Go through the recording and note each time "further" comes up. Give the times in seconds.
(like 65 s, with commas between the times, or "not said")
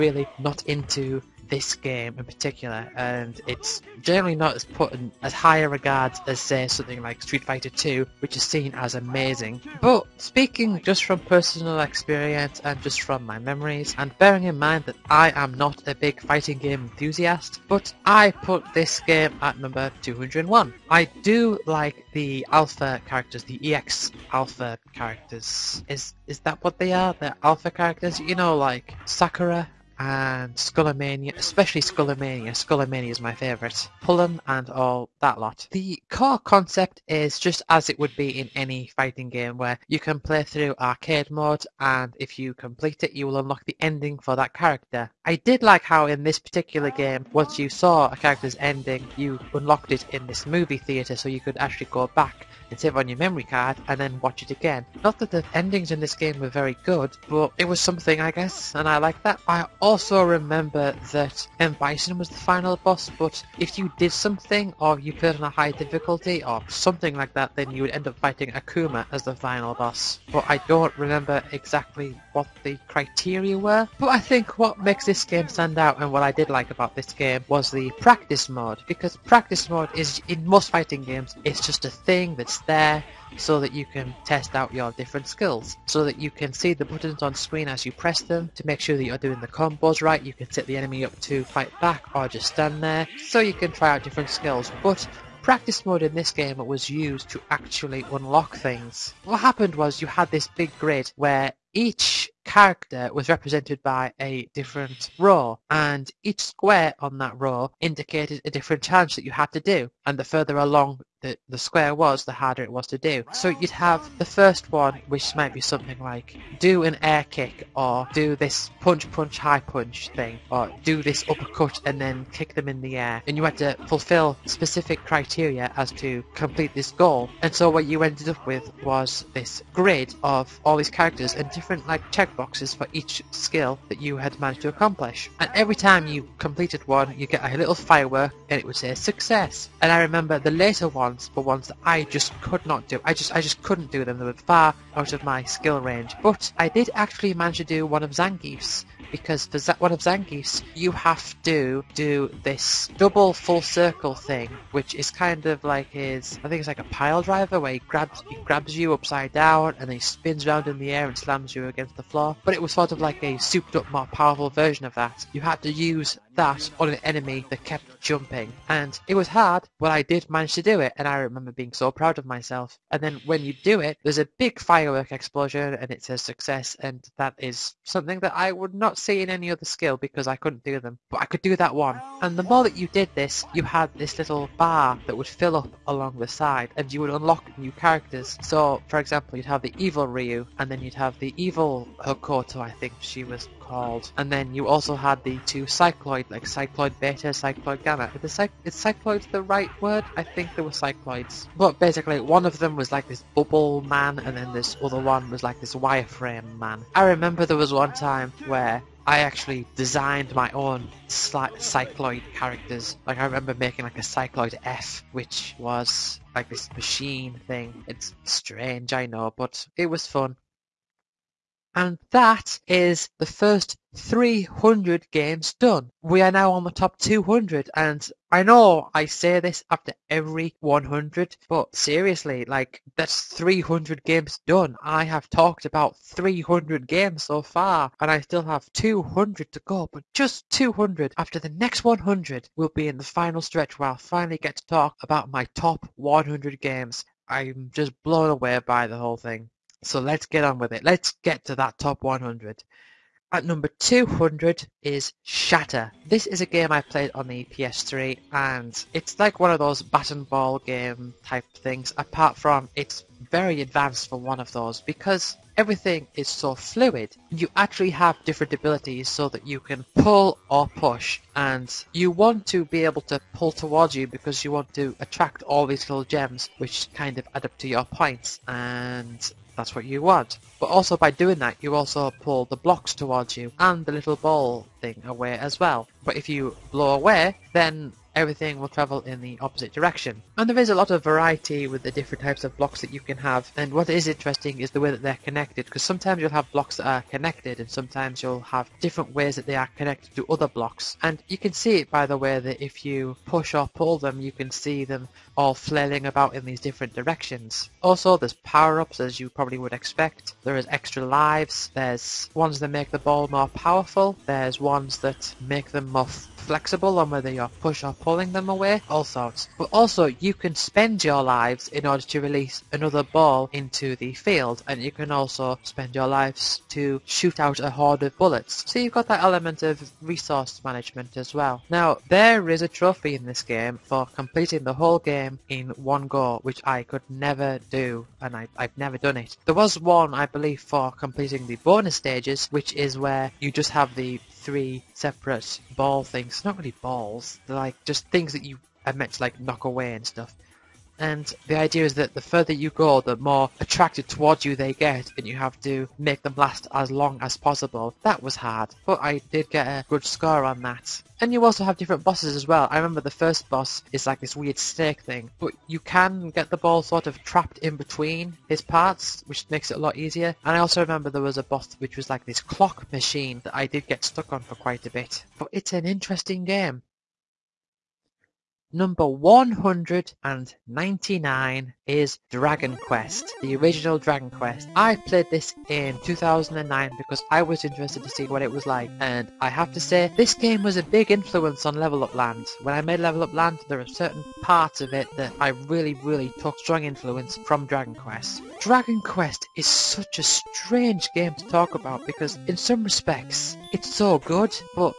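110 s, 352 s.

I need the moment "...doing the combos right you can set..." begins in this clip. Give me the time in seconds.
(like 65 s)
89 s.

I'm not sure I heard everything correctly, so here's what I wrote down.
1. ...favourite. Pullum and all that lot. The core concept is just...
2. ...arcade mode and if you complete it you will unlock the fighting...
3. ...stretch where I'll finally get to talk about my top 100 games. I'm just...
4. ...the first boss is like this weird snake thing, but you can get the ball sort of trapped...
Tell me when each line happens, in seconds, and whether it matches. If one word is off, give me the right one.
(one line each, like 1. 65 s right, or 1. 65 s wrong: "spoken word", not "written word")
1. 33 s right
2. 40 s wrong: "ending", not "fighting"
3. 243 s right
4. 363 s right.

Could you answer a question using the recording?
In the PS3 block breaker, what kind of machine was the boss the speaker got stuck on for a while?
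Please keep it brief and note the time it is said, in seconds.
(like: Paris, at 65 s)
clock machine, at 372 s.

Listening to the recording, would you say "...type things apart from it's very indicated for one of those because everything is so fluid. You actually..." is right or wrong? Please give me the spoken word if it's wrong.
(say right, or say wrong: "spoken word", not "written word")
wrong: "advanced", not "indicated".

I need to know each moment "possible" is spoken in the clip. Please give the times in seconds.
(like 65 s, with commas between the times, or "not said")
357 s.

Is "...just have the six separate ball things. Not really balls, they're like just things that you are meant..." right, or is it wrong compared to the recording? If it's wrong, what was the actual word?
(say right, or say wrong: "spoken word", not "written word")
wrong: "three", not "six".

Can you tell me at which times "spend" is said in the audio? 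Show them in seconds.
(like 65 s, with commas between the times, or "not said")
320 s, 325 s.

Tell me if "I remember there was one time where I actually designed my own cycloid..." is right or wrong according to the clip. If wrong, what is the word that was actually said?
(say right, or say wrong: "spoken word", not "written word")
right.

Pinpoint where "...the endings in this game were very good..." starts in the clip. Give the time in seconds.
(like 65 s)
55 s.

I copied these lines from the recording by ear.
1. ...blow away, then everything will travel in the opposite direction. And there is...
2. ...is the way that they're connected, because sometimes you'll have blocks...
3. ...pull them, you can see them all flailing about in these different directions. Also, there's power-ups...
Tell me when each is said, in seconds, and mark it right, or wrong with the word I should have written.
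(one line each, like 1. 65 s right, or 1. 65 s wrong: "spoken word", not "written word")
1. 286 s right
2. 294 s right
3. 303 s right.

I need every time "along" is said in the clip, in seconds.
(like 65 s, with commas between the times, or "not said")
110 s, 185 s.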